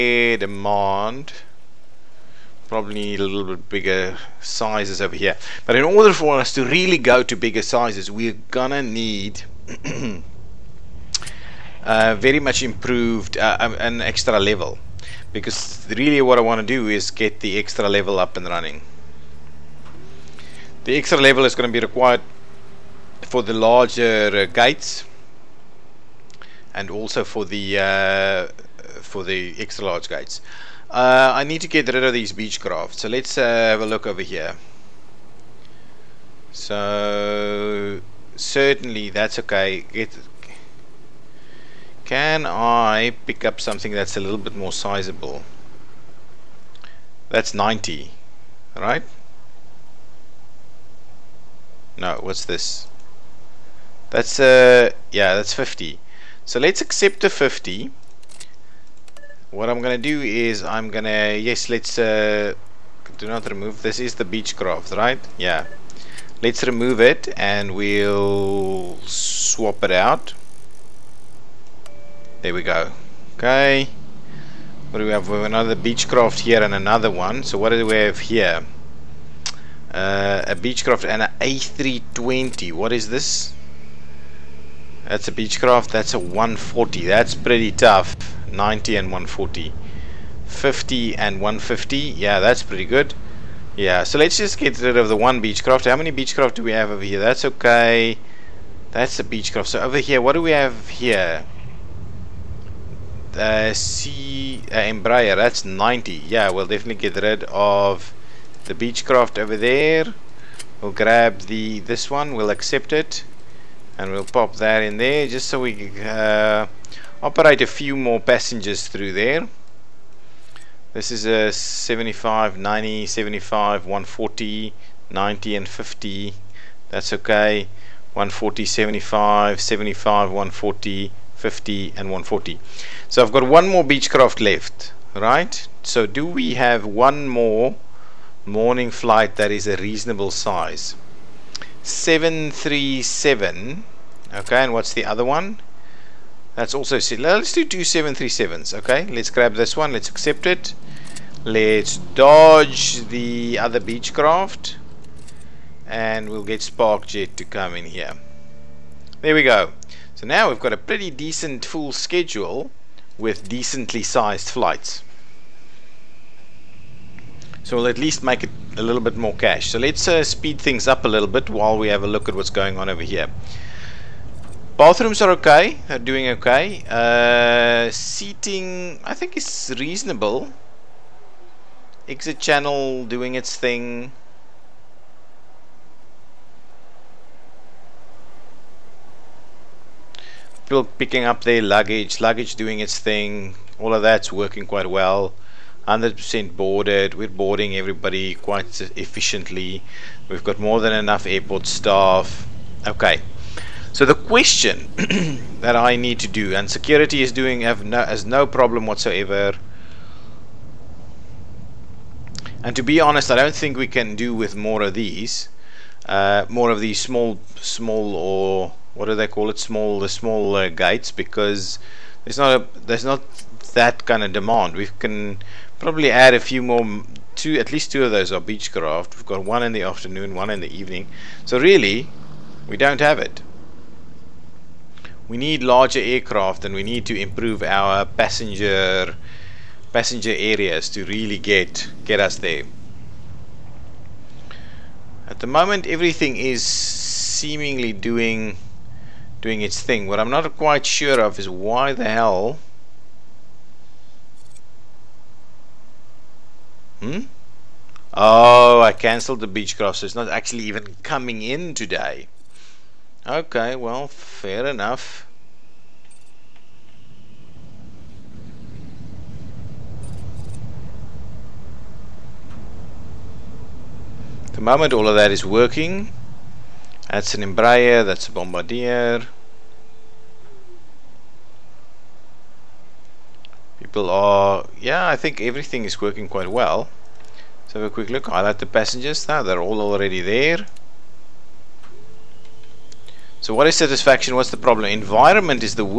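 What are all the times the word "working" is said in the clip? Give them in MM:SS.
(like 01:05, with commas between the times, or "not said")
03:14, 04:35, 04:45.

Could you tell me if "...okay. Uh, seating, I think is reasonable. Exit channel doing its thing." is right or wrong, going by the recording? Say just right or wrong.
right.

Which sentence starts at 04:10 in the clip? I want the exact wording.
What I'm not quite sure of is why the hell...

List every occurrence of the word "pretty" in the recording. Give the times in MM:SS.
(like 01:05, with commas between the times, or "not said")
01:27, 01:32, 02:40.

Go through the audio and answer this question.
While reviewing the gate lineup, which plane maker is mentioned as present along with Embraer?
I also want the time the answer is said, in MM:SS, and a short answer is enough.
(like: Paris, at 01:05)
Bombardier, at 04:38.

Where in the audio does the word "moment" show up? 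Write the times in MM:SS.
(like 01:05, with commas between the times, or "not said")
04:05, 04:34.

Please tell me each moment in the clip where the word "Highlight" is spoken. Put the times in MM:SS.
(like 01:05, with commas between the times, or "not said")
04:48.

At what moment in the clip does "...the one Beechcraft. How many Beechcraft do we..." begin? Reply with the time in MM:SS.
01:35.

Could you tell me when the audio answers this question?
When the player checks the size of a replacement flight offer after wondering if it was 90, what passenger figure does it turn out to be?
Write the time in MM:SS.
00:55.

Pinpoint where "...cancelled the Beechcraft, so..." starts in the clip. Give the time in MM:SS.
04:18.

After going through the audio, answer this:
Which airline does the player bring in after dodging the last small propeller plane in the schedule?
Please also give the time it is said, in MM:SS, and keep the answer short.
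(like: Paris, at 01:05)
Sparkjet, at 02:36.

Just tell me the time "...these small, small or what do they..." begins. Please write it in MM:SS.
03:36.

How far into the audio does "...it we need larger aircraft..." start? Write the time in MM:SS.
03:53.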